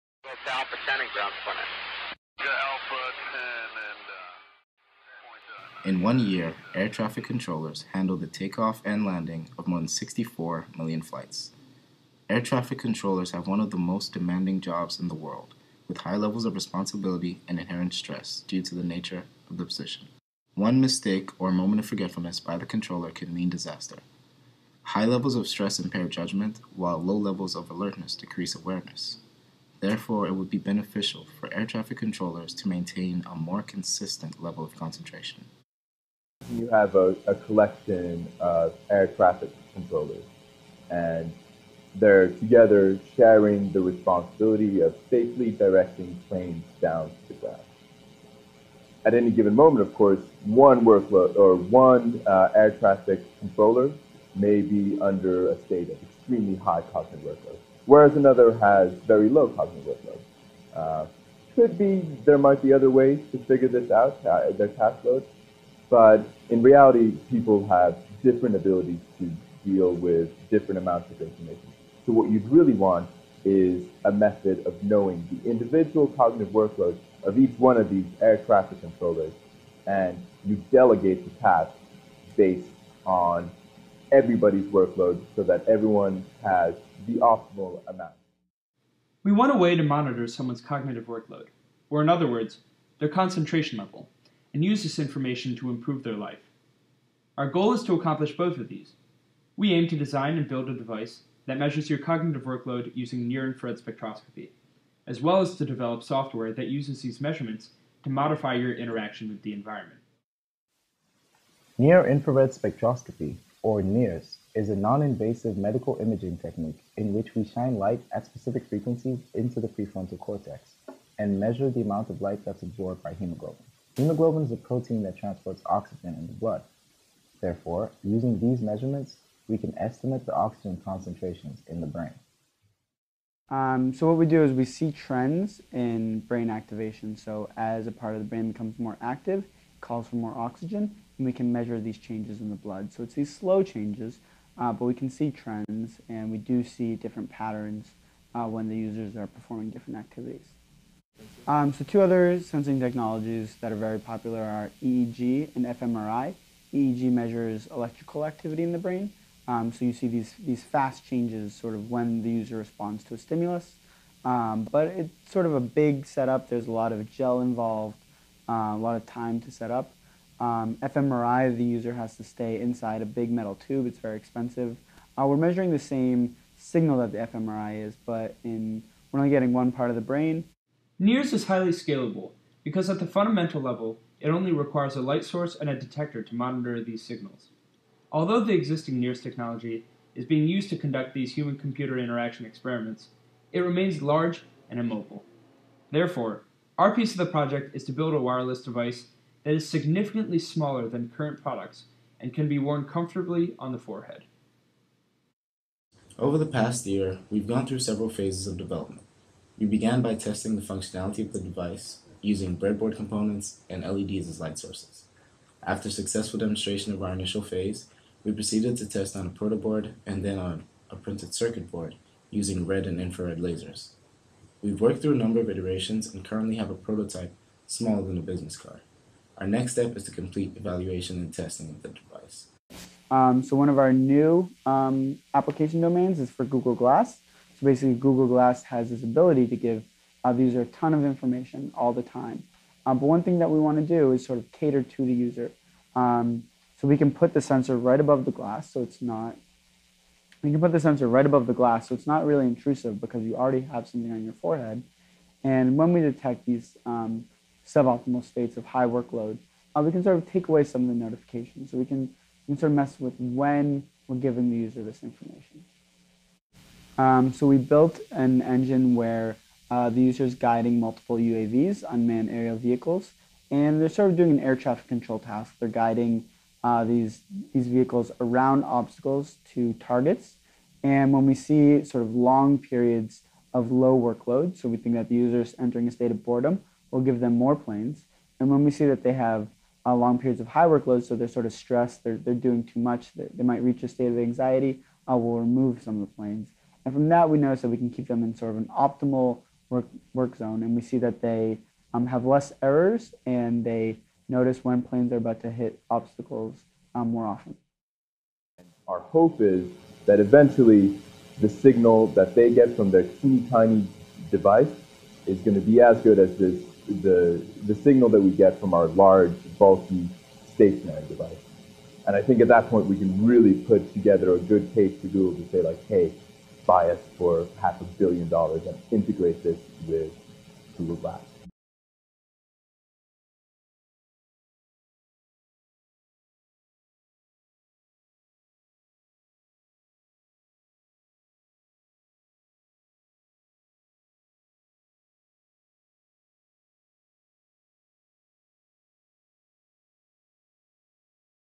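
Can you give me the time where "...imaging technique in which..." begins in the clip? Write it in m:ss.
1:56.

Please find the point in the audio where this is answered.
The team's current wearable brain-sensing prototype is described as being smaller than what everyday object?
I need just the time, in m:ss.
3:48.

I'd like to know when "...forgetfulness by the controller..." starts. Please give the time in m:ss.
0:21.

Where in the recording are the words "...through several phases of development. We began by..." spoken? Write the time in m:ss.
3:27.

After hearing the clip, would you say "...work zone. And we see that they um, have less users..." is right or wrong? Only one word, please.
wrong.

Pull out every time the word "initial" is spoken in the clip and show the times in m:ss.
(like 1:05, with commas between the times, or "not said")
3:37.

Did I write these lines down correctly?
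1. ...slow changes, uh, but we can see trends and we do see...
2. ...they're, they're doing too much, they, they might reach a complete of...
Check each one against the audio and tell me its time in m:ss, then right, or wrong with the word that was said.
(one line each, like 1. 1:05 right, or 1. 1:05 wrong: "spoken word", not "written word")
1. 2:23 right
2. 4:52 wrong: "state", not "complete".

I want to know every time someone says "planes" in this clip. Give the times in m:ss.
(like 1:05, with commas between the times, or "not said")
0:46, 4:47, 4:56, 5:04.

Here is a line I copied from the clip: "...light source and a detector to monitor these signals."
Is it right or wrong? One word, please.
right.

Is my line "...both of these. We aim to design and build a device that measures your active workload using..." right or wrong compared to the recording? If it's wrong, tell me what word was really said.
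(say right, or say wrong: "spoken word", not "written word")
wrong: "cognitive", not "active".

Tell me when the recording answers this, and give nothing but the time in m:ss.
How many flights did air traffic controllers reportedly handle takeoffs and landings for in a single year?
0:09.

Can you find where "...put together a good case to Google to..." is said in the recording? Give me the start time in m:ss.
5:23.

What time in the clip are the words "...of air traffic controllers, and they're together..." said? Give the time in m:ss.
0:38.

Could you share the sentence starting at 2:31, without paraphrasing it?
Um, so two other sensing technologies that are very popular are EEG and fMRI.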